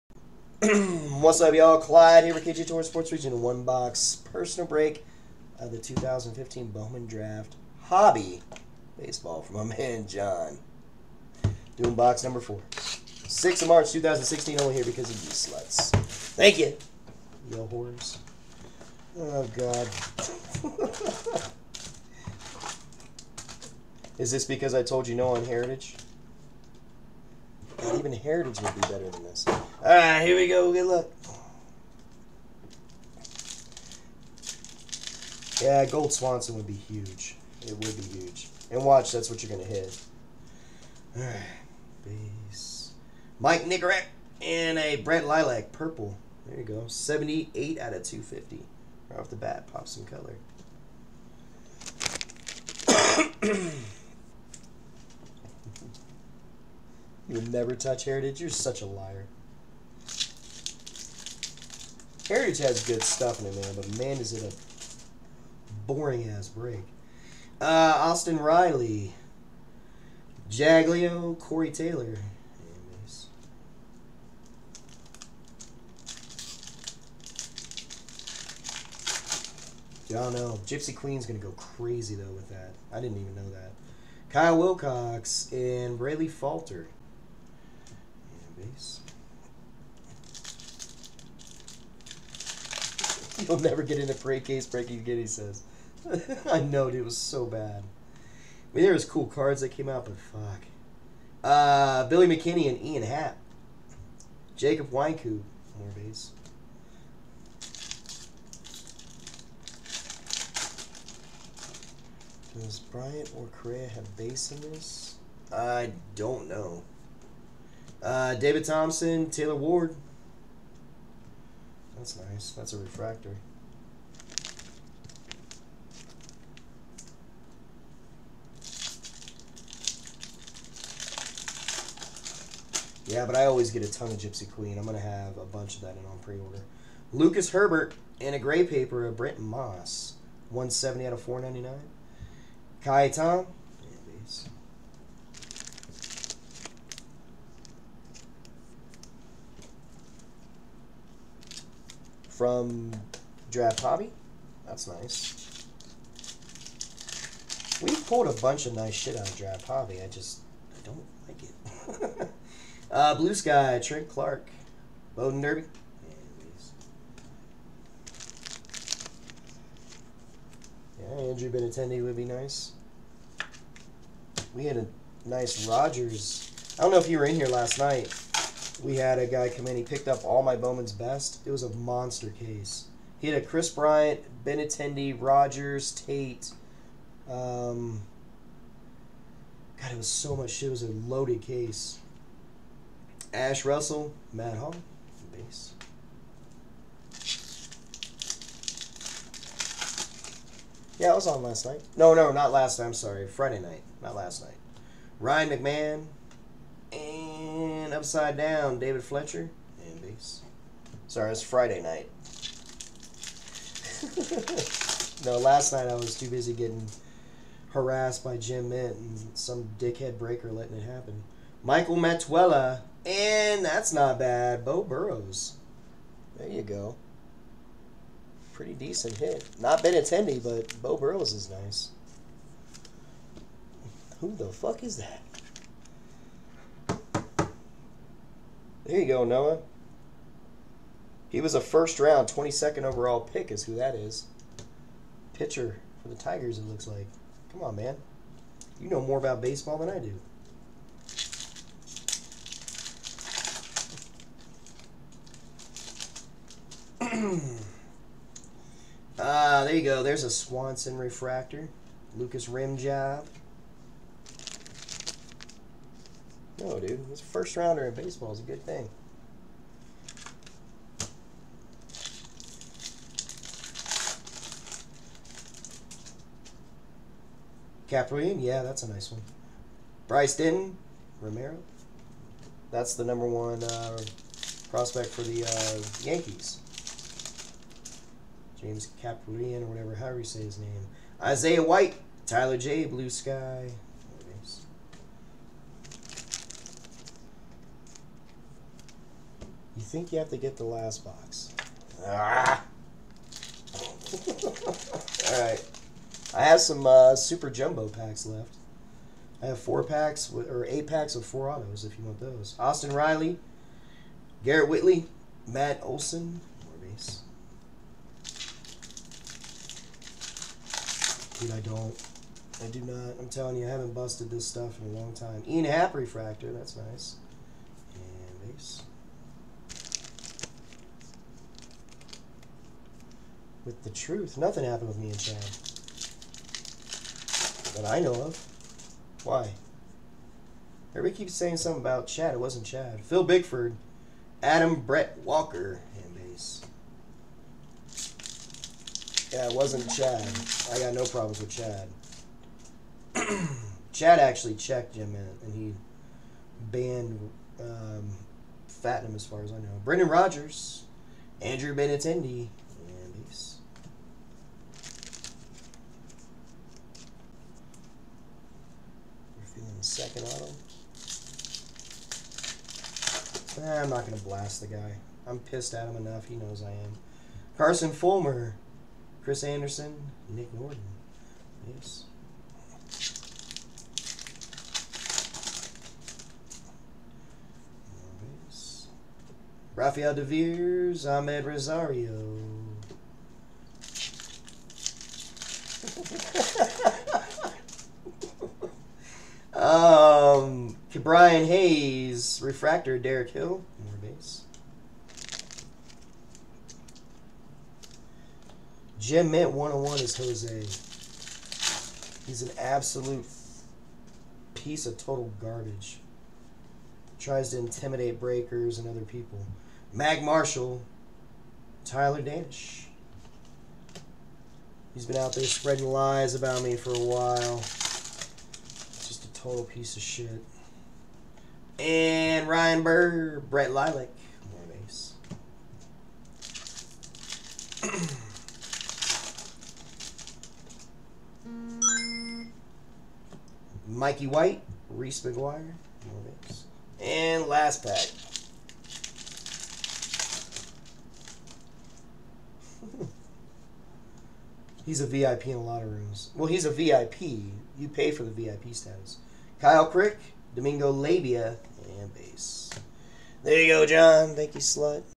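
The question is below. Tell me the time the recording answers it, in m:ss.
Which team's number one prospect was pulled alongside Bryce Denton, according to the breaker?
4:46.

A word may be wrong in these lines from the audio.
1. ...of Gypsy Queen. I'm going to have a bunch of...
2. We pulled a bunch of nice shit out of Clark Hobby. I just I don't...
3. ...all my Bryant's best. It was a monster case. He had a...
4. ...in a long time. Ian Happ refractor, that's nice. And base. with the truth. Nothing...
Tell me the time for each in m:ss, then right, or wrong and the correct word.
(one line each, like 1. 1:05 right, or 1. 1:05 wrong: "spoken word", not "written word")
1. 2:14 right
2. 2:37 wrong: "Draft", not "Clark"
3. 3:00 wrong: "Bowman", not "Bryant"
4. 5:24 right.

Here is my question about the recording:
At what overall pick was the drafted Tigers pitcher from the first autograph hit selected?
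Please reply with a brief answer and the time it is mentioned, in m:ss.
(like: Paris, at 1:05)
22nd overall, at 4:02.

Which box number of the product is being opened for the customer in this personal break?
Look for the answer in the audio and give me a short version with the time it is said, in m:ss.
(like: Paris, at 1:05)
4, at 0:11.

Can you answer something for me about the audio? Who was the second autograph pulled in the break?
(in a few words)
Andrew Benintendi.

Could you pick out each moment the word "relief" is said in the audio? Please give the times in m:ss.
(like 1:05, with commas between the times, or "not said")
not said.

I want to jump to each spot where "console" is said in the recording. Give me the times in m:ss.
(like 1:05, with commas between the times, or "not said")
not said.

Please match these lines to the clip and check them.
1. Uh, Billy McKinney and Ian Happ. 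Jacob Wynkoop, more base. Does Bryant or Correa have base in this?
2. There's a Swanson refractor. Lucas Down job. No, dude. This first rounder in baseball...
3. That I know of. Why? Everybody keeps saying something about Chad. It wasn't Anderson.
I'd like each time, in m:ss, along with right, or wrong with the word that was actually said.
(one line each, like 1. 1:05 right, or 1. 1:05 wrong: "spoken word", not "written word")
1. 1:41 right
2. 4:20 wrong: "Rim", not "Down"
3. 5:37 wrong: "Chad", not "Anderson".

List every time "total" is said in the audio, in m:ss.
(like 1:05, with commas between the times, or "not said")
6:54, 7:09.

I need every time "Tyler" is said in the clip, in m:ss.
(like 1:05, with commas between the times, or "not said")
4:52, 7:01.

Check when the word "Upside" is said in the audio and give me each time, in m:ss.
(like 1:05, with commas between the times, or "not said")
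3:27.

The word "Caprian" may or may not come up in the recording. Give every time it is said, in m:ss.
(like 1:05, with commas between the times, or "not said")
4:37, 4:49.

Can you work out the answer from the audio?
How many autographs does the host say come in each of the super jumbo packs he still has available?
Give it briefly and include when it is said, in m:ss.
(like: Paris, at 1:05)
4, at 5:11.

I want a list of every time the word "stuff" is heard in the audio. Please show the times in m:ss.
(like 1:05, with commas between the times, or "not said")
1:03, 5:24.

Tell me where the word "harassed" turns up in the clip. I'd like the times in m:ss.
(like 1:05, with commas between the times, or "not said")
3:37.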